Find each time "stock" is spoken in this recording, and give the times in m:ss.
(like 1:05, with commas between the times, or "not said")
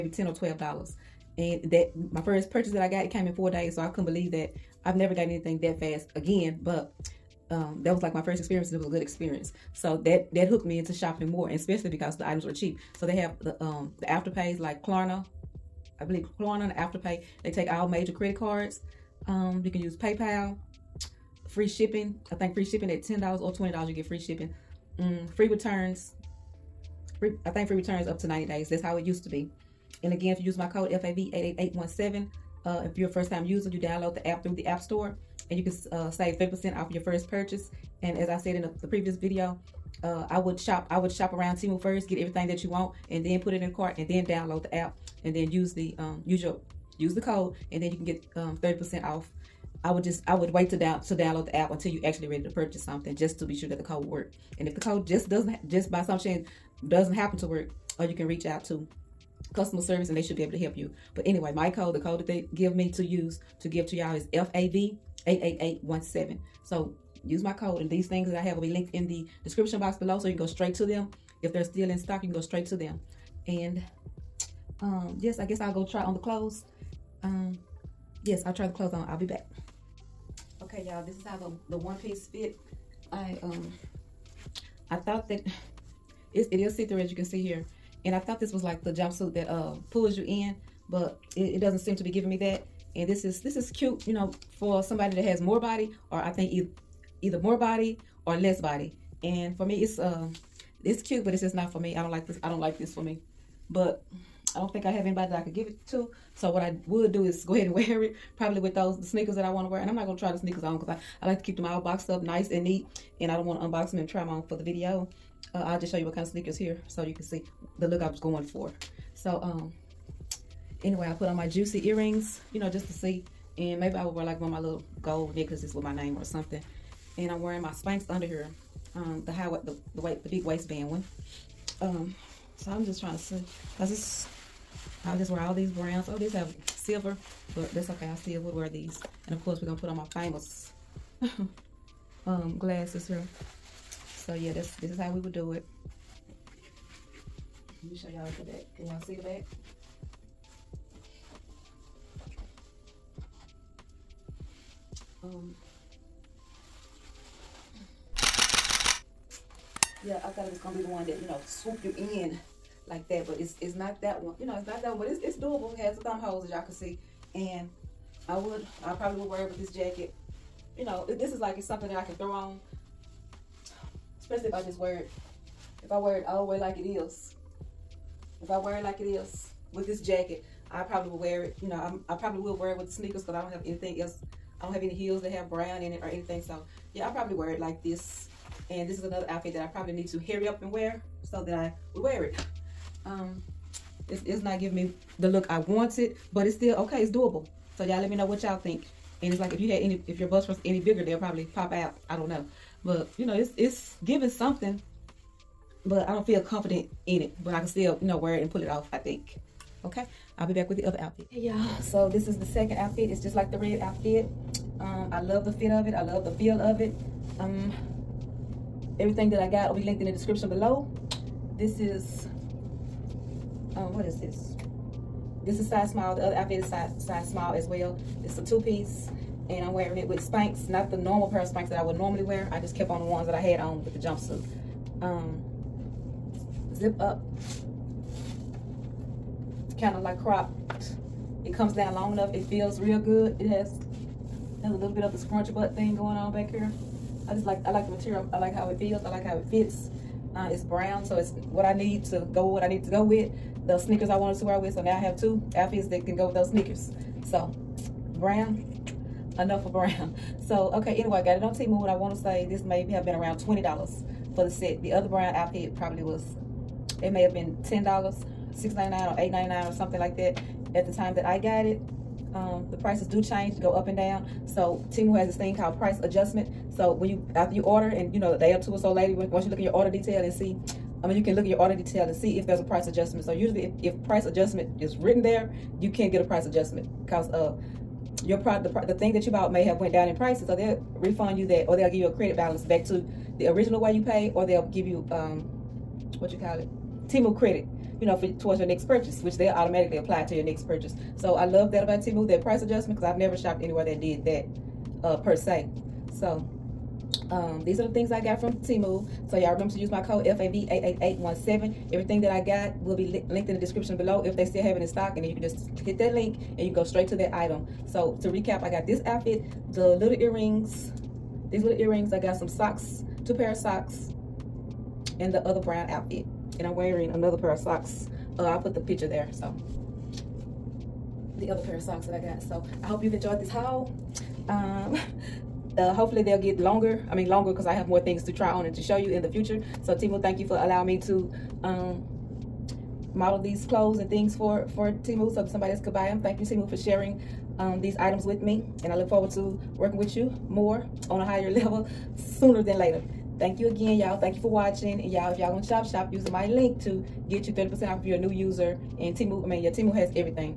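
1:11, 5:14.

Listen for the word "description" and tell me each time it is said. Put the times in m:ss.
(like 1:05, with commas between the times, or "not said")
1:09, 3:40, 5:13.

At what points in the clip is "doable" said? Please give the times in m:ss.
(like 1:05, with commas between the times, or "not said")
2:45, 3:17.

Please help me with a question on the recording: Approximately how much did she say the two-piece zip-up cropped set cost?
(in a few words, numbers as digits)
$20.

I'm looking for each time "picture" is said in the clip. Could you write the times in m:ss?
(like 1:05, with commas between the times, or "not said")
5:28.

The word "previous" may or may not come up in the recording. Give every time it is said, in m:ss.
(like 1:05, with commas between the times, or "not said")
0:38.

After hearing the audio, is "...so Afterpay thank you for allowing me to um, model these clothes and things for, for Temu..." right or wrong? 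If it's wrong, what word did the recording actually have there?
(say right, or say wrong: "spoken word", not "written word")
wrong: "Temu", not "Afterpay".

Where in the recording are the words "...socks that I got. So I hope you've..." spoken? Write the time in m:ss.
5:31.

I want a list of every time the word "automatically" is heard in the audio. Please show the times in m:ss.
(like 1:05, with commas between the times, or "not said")
4:59.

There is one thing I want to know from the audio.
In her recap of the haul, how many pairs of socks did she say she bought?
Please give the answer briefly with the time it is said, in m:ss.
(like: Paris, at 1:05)
2, at 5:23.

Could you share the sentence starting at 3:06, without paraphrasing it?
So yeah, I probably wear it like this.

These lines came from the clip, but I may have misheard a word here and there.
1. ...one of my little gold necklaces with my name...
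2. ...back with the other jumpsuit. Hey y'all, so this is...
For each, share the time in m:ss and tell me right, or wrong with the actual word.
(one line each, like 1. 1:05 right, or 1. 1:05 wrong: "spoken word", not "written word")
1. 2:04 right
2. 3:30 wrong: "outfit", not "jumpsuit".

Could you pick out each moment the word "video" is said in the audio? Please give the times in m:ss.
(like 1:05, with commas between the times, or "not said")
0:39, 1:54.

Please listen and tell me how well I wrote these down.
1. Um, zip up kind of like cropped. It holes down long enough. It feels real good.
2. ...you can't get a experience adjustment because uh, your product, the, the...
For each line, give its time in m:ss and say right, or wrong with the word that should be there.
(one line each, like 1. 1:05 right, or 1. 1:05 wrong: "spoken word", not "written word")
1. 3:55 wrong: "comes", not "holes"
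2. 4:45 wrong: "price", not "experience".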